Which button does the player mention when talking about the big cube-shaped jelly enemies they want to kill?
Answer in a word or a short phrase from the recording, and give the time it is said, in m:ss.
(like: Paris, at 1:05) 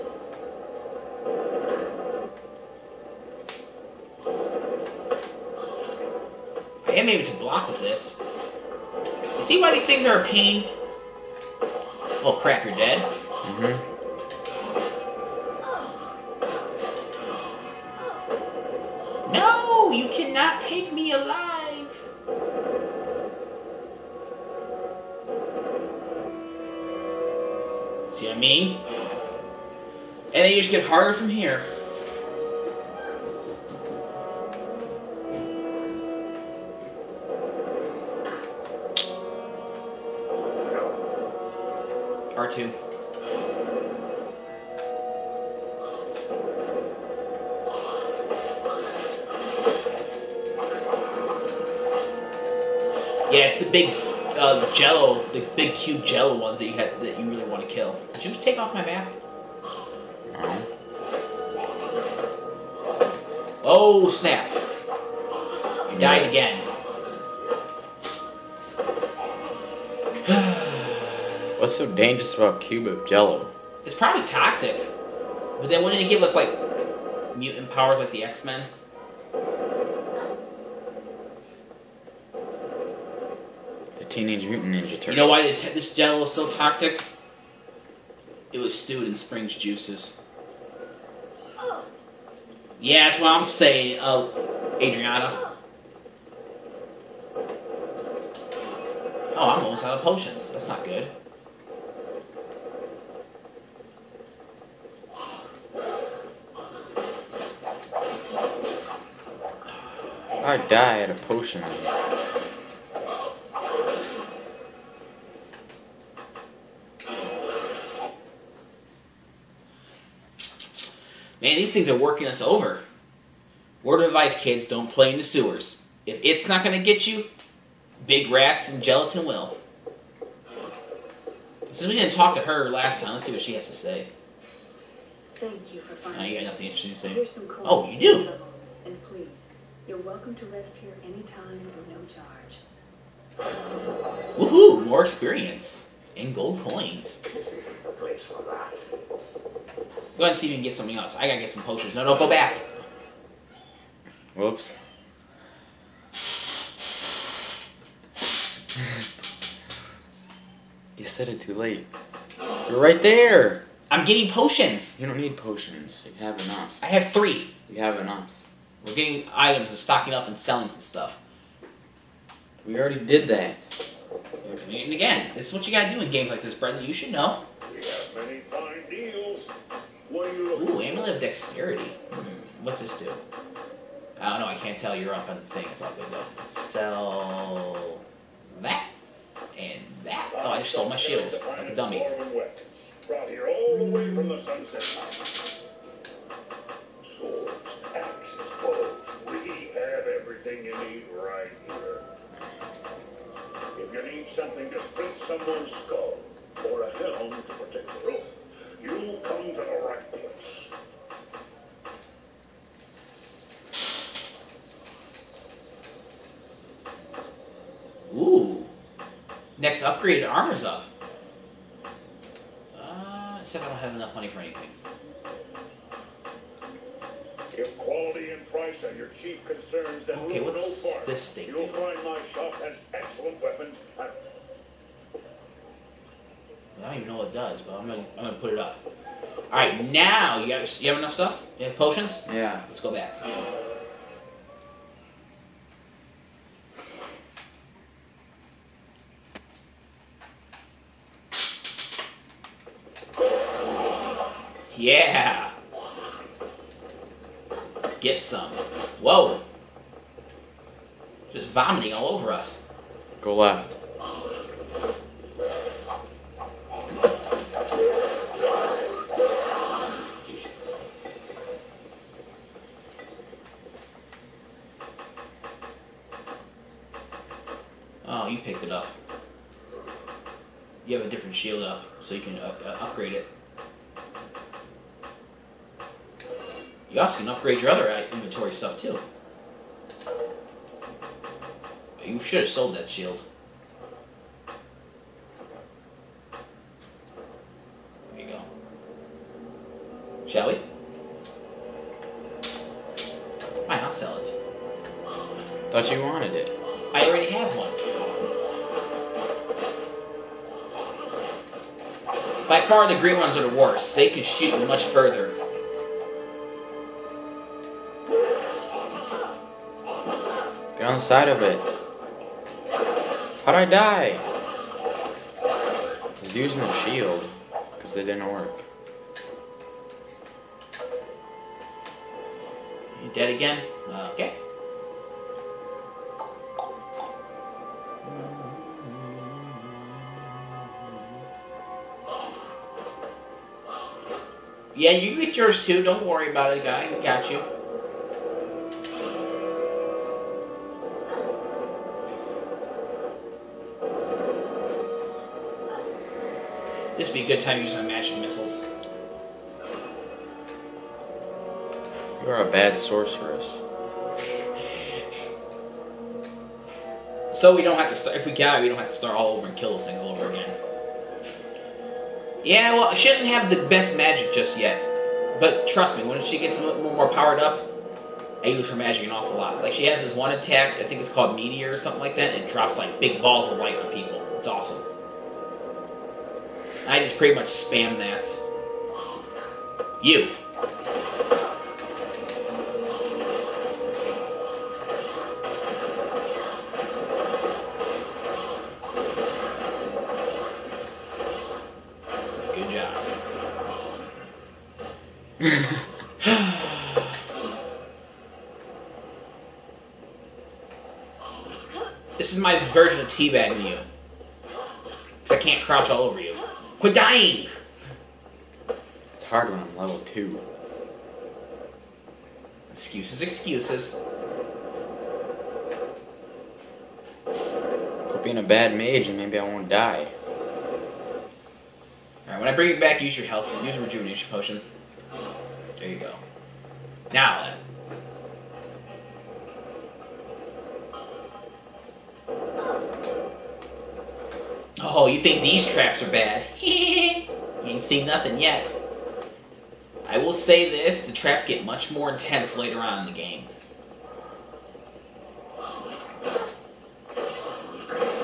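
R2, at 0:42.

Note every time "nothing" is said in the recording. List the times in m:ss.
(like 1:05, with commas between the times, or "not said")
2:16, 7:28.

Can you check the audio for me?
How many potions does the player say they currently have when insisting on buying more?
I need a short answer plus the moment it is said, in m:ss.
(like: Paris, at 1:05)
3, at 2:47.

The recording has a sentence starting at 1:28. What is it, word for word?
It was stewed in spring's juices.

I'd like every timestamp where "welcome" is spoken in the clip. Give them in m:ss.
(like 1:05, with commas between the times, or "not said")
2:19.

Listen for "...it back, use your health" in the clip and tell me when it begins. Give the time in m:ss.
7:12.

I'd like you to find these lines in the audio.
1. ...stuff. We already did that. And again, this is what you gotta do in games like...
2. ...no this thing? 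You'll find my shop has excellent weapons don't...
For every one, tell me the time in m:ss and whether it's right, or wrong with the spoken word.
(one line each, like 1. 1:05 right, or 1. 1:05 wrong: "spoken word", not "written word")
1. 2:50 right
2. 3:50 right.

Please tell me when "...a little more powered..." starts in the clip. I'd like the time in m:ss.
6:16.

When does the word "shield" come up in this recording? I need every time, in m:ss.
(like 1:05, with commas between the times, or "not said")
3:10, 4:41, 4:52, 5:26.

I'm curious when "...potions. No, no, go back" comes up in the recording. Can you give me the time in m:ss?
2:31.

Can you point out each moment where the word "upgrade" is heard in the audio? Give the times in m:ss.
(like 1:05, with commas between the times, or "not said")
3:39, 4:42, 4:47.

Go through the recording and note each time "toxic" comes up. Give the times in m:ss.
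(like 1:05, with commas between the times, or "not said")
1:14, 1:26.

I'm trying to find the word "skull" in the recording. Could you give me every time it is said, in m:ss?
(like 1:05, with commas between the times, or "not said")
3:25.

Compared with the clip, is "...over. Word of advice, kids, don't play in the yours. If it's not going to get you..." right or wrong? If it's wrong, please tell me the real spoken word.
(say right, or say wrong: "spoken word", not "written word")
wrong: "sewers", not "yours".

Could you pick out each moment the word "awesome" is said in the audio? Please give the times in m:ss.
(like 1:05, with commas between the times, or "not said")
6:24.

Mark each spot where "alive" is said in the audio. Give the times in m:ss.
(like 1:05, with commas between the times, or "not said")
0:21.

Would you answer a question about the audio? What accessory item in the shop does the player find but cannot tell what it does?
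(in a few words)
Amulet of Dexterity.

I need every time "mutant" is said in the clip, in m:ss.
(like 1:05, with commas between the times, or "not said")
1:17, 1:24.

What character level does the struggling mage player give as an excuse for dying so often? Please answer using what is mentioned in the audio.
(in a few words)
2.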